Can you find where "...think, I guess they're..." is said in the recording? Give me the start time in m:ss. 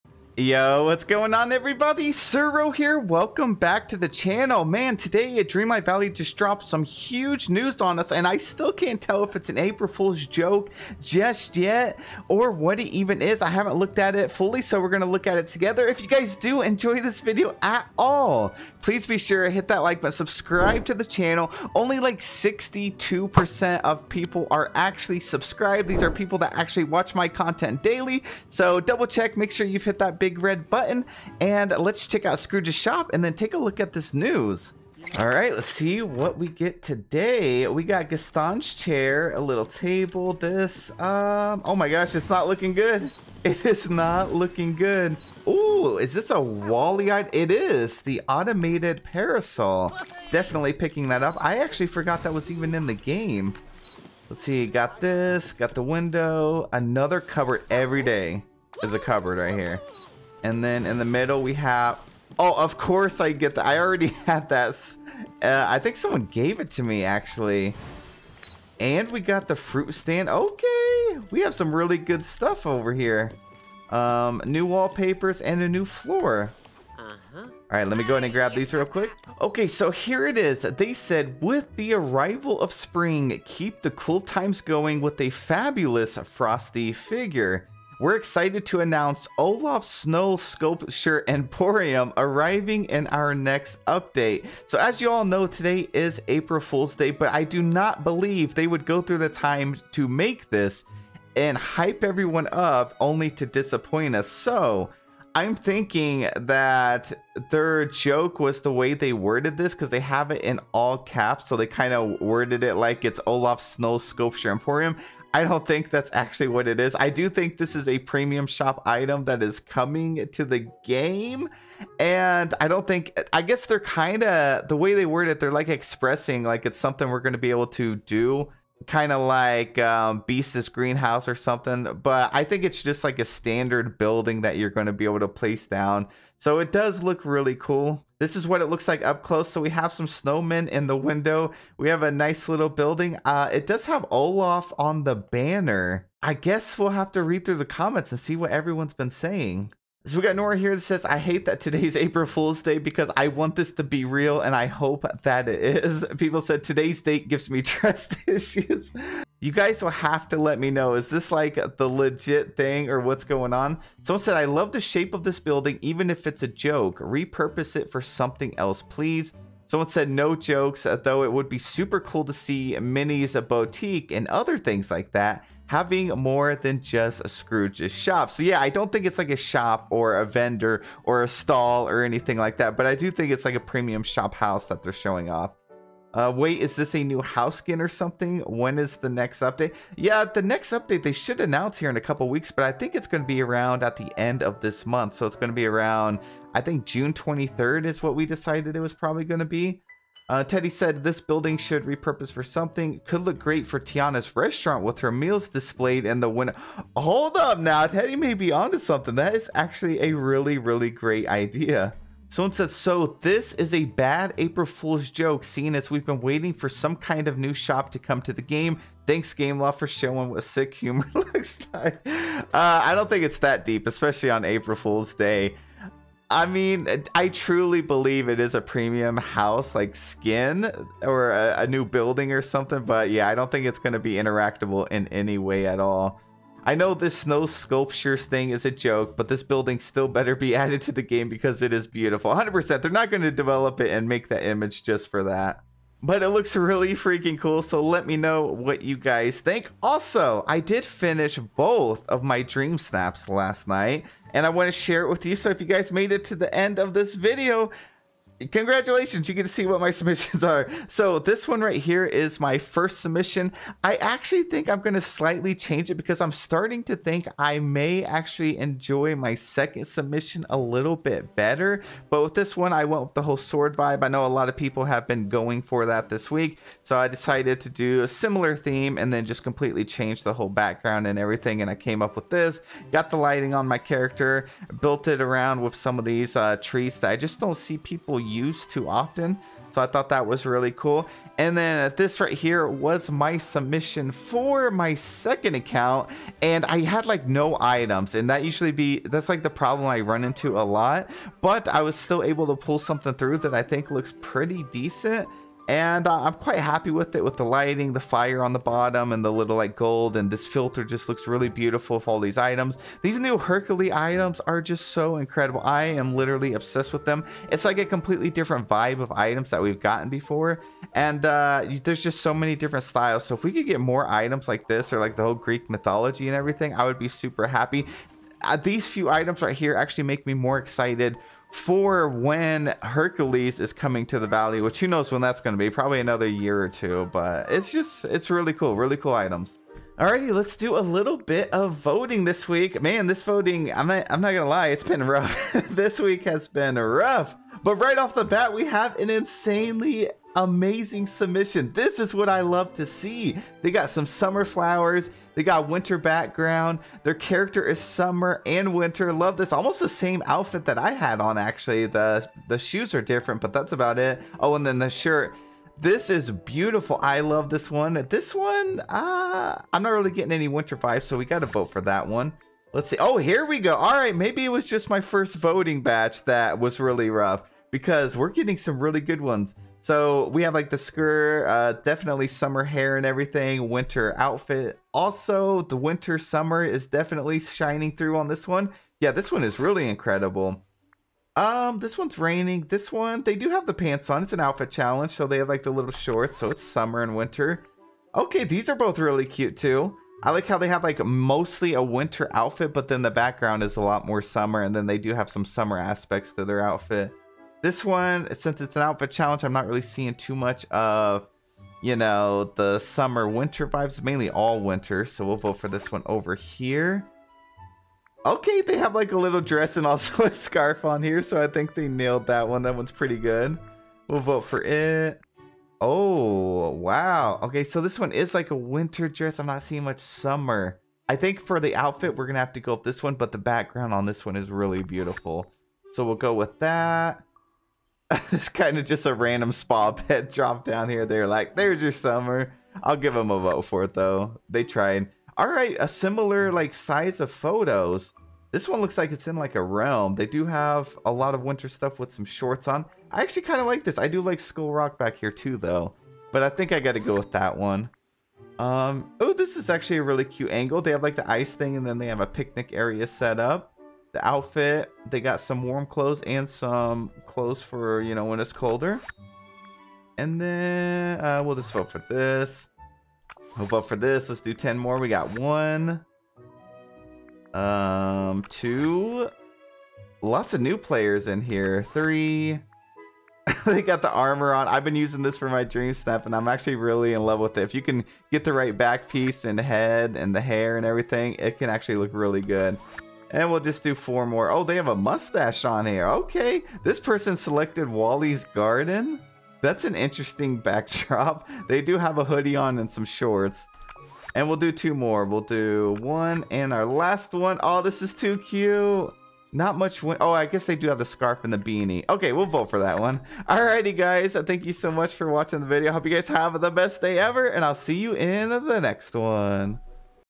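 2:02.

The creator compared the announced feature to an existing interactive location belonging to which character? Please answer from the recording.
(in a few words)
Beast's Greenhouse.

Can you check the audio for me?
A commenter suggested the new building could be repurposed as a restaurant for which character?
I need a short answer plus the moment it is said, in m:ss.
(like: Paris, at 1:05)
Tiana, at 3:23.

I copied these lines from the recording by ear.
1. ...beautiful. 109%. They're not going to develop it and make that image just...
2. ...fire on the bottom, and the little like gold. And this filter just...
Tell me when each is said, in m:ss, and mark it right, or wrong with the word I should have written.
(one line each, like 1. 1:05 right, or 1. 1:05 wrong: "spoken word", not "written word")
1. 4:01 wrong: "100", not "109"
2. 5:08 right.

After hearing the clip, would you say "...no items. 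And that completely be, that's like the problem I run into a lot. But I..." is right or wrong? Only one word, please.
wrong.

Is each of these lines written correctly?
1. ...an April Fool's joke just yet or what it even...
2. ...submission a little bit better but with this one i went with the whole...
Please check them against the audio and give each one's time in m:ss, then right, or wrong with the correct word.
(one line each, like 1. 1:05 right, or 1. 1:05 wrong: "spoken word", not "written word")
1. 0:09 right
2. 4:29 right.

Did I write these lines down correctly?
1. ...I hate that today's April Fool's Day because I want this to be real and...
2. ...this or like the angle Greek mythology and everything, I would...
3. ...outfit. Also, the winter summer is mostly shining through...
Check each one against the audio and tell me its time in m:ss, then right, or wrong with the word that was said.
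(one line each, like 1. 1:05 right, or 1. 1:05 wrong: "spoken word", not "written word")
1. 2:31 right
2. 5:24 wrong: "whole", not "angle"
3. 6:24 wrong: "definitely", not "mostly".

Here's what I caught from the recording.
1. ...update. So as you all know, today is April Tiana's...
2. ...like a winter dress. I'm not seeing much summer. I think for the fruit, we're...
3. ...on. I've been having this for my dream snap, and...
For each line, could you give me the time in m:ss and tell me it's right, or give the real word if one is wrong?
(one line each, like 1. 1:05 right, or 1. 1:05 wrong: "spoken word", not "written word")
1. 1:33 wrong: "Fool", not "Tiana"
2. 7:08 wrong: "outfit", not "fruit"
3. 8:04 wrong: "using", not "having".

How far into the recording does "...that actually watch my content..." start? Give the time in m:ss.
0:26.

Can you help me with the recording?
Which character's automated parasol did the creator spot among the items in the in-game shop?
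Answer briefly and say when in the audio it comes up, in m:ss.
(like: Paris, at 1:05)
Wall-E, at 0:46.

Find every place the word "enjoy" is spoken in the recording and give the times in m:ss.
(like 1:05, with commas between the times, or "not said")
0:16, 4:28.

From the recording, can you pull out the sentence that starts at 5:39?
Alrighty, let's do a little bit of voting this week.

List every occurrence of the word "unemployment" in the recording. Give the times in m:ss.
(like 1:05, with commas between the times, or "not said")
not said.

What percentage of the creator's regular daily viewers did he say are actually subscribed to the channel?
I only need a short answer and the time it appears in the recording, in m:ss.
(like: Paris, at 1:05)
62%, at 0:22.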